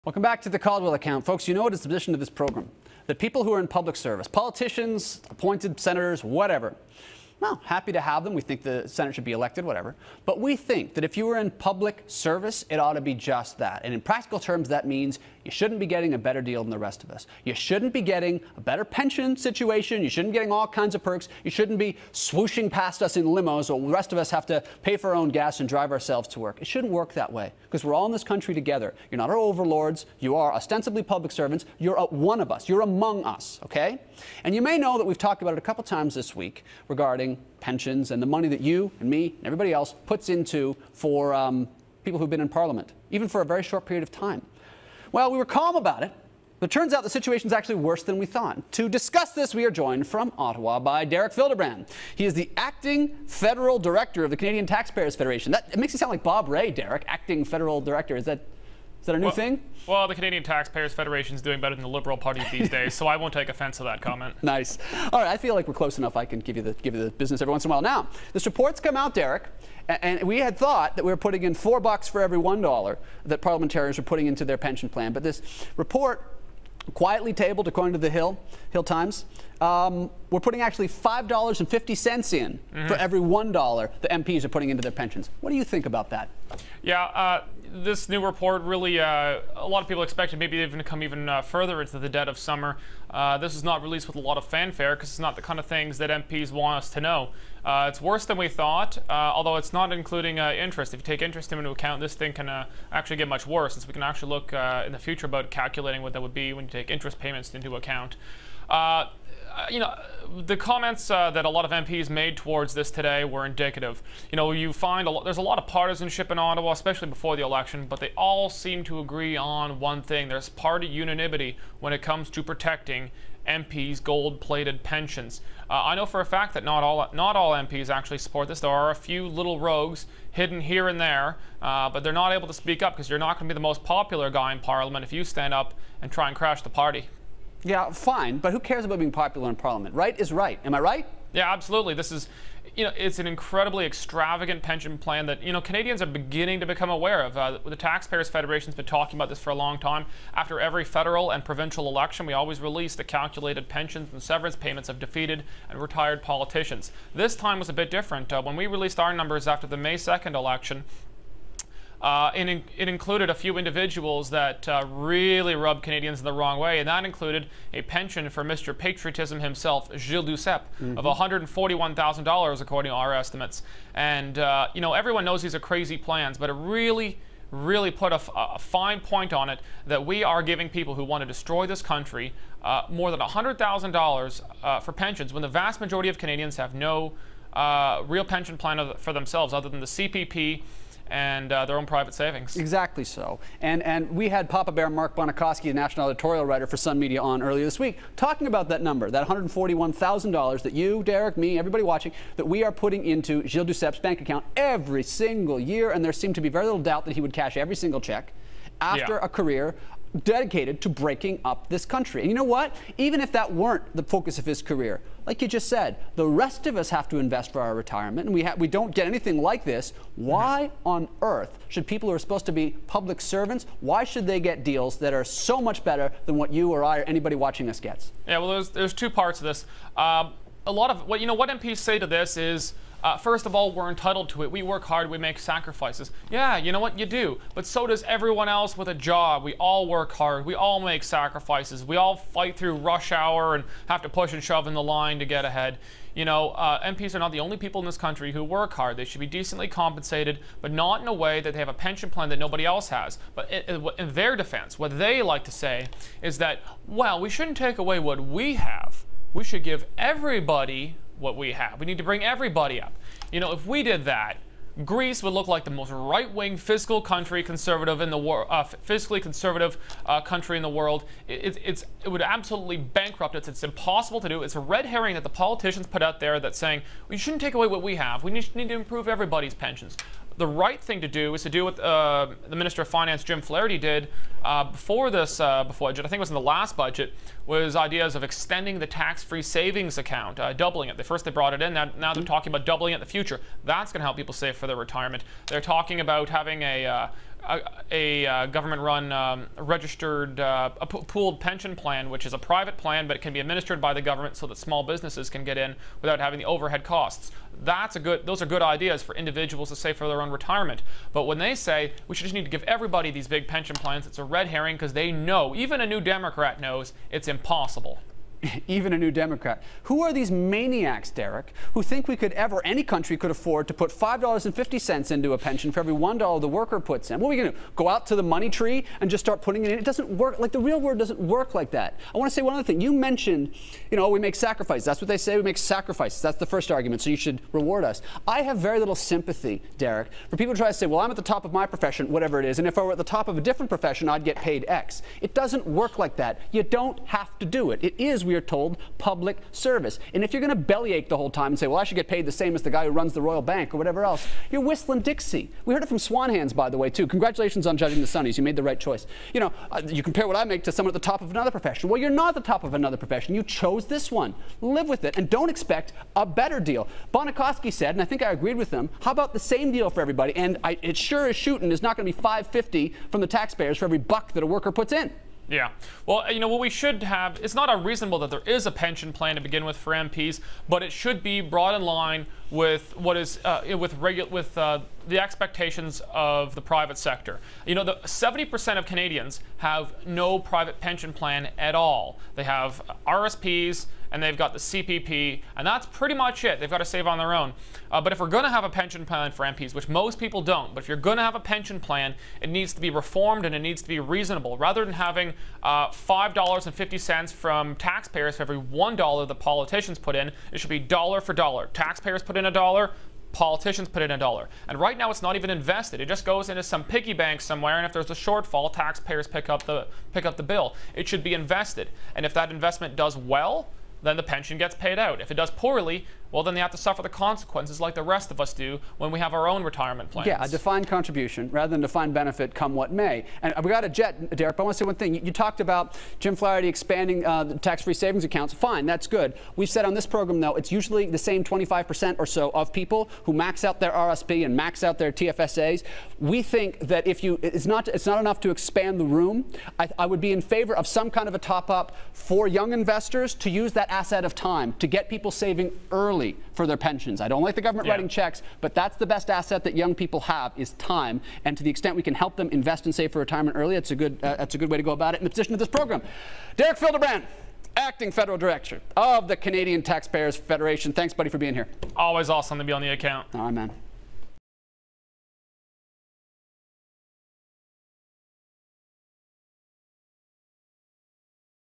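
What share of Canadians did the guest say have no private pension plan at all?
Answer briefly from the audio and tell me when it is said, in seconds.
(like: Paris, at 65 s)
70%, at 387 s.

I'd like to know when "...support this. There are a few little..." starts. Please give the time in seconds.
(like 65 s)
128 s.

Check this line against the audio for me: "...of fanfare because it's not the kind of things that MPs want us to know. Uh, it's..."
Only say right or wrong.
right.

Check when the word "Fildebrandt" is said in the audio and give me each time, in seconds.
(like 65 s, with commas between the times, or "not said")
51 s, 466 s.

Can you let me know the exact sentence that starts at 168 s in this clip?
Patriotism himself, Gilles Duceppe, mm -hmm.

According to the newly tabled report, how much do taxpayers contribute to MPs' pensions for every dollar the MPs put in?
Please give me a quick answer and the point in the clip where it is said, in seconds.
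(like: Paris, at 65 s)
$5.50, at 80 s.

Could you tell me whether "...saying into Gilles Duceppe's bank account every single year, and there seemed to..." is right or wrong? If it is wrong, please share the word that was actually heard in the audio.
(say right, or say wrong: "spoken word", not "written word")
wrong: "putting", not "saying".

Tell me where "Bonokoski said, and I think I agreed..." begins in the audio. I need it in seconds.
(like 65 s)
367 s.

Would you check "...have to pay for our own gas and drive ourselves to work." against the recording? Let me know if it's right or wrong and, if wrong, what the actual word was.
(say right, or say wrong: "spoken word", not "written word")
right.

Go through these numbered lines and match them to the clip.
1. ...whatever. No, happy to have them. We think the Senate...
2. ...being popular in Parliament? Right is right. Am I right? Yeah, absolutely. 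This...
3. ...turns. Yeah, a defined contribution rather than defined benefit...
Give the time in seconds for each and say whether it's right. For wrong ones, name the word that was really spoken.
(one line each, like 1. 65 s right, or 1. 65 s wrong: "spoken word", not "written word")
1. 6 s right
2. 138 s right
3. 430 s wrong: "plans", not "turns".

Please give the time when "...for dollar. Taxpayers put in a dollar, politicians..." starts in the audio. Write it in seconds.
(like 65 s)
411 s.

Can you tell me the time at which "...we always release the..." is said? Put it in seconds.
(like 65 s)
152 s.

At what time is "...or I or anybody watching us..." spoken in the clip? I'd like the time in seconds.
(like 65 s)
226 s.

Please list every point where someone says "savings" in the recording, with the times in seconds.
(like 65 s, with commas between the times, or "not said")
192 s, 289 s, 437 s, 455 s.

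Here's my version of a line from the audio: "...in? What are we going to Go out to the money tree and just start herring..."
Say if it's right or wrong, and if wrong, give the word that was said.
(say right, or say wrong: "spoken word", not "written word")
wrong: "putting", not "herring".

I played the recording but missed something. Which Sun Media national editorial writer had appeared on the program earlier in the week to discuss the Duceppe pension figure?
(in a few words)
Mark Bonokoski.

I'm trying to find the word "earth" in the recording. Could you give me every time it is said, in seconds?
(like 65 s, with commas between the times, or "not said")
221 s.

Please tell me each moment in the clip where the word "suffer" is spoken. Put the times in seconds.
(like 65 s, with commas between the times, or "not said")
426 s.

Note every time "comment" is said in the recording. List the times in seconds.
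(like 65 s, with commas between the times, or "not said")
63 s, 110 s.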